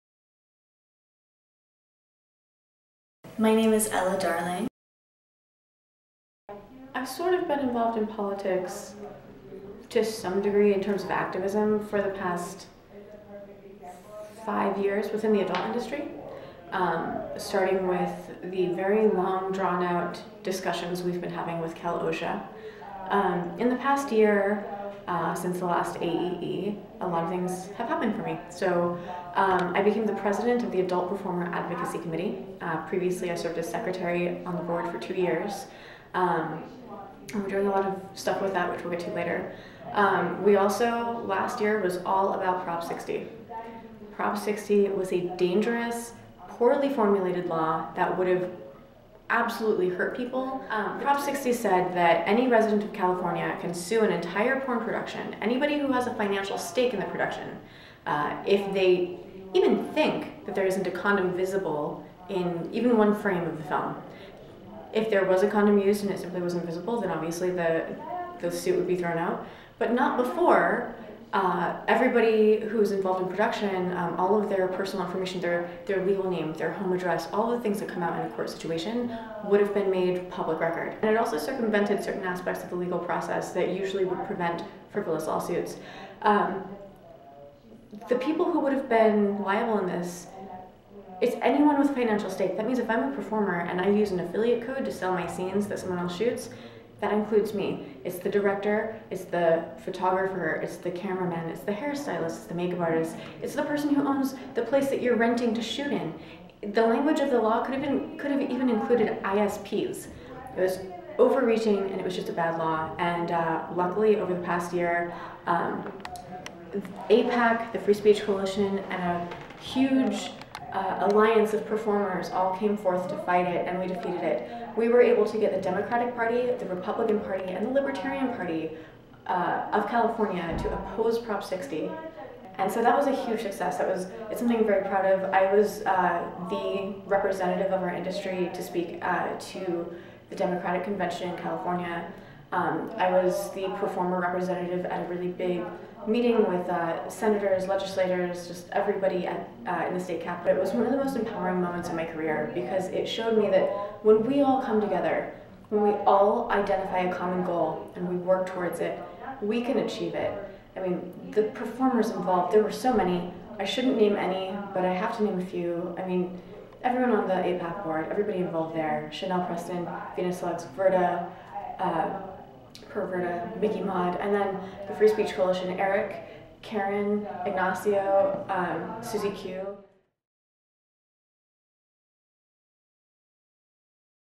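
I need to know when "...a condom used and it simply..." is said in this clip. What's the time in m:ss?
1:05.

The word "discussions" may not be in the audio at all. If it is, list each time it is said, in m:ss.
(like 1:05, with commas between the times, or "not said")
0:20.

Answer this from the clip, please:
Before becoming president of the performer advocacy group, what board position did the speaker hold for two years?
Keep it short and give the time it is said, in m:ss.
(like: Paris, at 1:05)
Secretary, at 0:33.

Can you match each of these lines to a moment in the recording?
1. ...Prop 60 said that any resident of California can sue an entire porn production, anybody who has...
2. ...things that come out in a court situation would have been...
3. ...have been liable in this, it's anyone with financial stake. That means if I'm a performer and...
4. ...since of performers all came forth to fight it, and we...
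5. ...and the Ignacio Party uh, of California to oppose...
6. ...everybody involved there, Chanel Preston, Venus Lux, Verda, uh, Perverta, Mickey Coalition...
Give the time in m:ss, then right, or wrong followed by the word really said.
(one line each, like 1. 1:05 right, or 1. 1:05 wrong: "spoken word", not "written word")
1. 0:51 right
2. 1:17 right
3. 1:28 right
4. 2:01 wrong: "alliance", not "since"
5. 2:07 wrong: "Libertarian", not "Ignacio"
6. 2:48 wrong: "Mod", not "Coalition".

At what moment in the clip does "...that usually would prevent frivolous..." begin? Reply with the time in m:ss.
1:23.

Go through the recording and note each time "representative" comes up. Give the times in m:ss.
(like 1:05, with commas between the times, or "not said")
2:17, 2:24.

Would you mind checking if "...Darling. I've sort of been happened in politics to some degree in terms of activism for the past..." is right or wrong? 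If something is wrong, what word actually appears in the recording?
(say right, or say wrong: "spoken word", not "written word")
wrong: "involved", not "happened".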